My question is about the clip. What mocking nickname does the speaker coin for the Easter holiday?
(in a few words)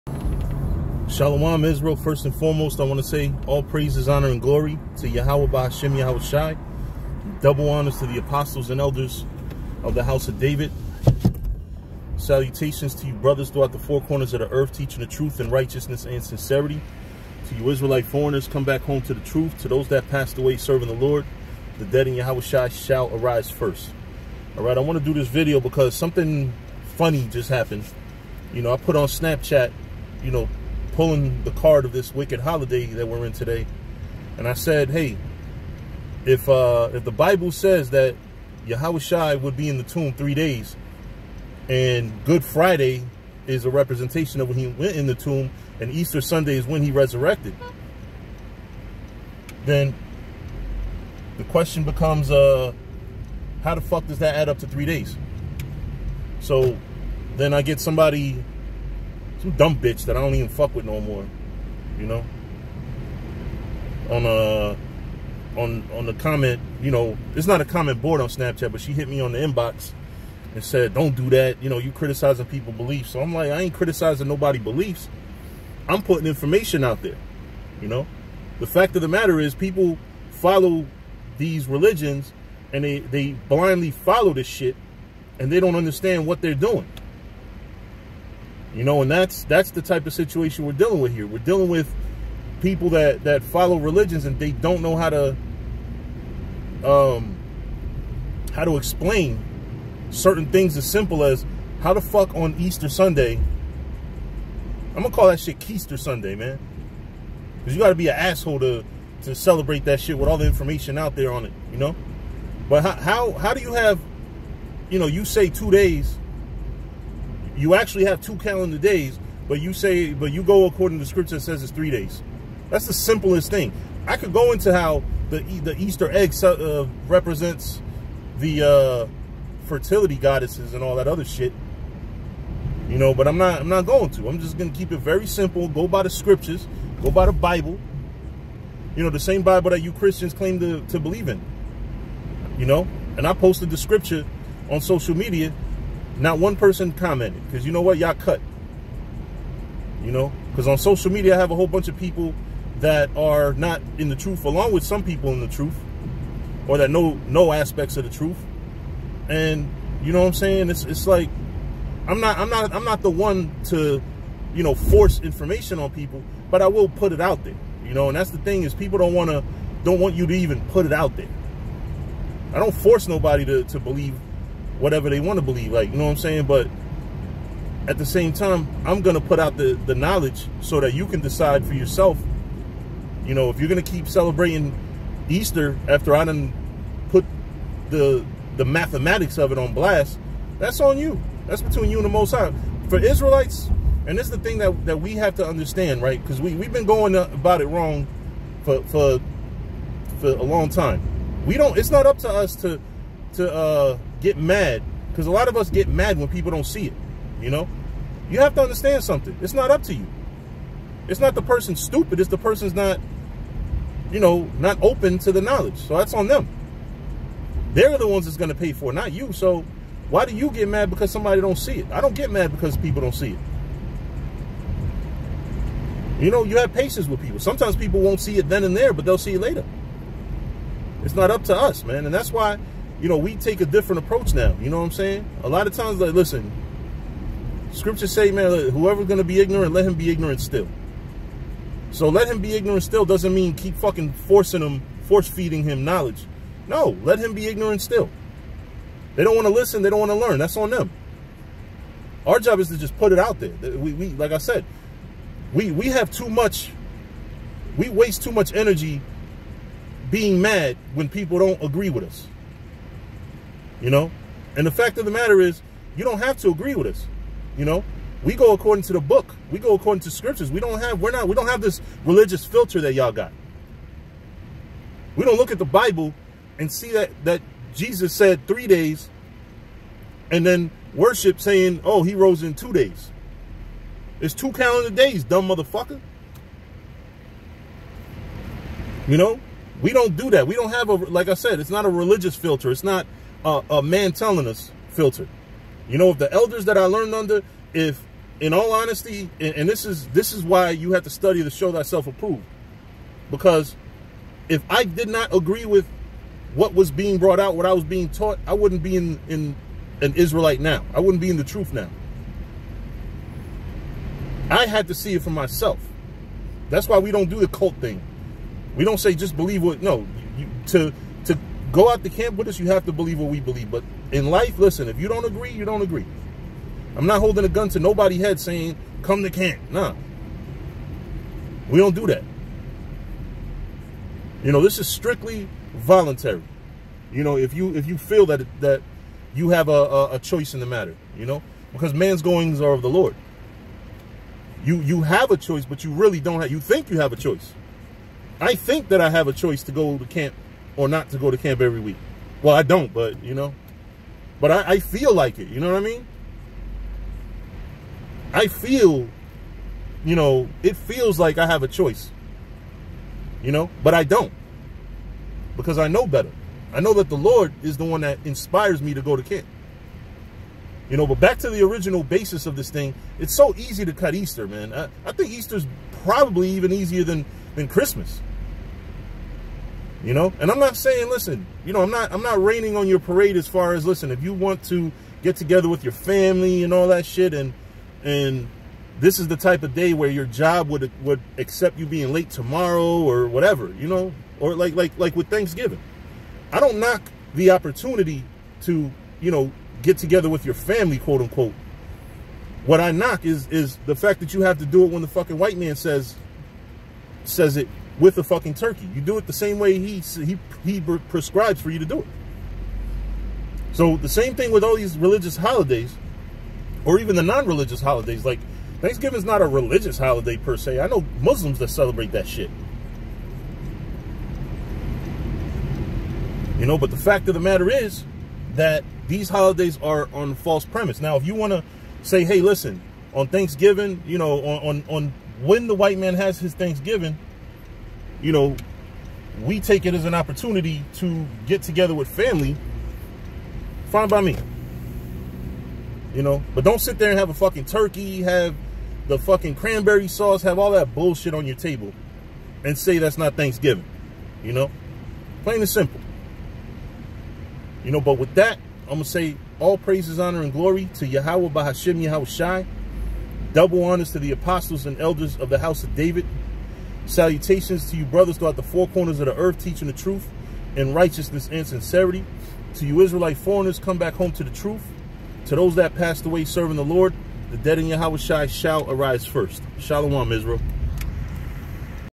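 Keister Sunday.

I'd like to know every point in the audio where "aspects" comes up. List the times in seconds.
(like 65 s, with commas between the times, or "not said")
157 s.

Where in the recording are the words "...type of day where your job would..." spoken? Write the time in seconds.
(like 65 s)
389 s.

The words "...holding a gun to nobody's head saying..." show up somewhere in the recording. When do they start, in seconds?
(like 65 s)
327 s.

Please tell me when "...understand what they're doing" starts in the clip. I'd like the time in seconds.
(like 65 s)
85 s.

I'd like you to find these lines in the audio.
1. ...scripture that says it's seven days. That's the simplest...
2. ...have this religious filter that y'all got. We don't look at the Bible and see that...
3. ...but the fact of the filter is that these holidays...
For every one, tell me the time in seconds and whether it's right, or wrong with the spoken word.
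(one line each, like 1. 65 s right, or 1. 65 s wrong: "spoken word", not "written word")
1. 121 s wrong: "three", not "seven"
2. 271 s right
3. 426 s wrong: "matter", not "filter".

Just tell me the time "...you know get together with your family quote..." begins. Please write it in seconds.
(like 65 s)
399 s.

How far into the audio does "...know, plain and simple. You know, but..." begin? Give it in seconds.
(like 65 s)
454 s.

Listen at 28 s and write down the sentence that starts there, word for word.
You know, I put on Snapchat, you know, pulling the card of this wicked holiday that we're in today.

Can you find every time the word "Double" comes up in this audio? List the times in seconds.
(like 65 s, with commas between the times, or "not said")
7 s, 463 s.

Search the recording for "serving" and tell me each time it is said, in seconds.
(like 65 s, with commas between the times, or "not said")
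20 s, 476 s.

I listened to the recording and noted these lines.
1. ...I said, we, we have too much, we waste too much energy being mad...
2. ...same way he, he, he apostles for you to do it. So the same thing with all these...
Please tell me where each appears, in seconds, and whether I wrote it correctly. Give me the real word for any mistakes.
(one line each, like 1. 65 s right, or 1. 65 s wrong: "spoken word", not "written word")
1. 254 s right
2. 409 s wrong: "prescribes", not "apostles".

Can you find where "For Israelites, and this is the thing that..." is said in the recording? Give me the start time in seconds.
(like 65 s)
192 s.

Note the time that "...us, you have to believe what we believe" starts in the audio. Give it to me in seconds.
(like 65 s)
322 s.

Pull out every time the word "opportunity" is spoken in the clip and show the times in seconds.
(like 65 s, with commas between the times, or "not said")
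397 s, 440 s.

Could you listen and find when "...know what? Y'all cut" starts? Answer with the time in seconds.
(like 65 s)
147 s.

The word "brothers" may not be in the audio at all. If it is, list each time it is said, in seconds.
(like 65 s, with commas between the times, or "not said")
13 s, 468 s.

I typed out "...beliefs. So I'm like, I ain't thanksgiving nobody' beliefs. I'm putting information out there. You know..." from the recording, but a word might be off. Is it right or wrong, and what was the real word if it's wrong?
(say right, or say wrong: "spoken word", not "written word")
wrong: "criticizing", not "thanksgiving".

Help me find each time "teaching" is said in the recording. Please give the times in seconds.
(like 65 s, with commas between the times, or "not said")
14 s, 469 s.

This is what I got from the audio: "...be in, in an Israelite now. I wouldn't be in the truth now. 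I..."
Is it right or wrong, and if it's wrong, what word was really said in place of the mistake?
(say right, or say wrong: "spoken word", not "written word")
right.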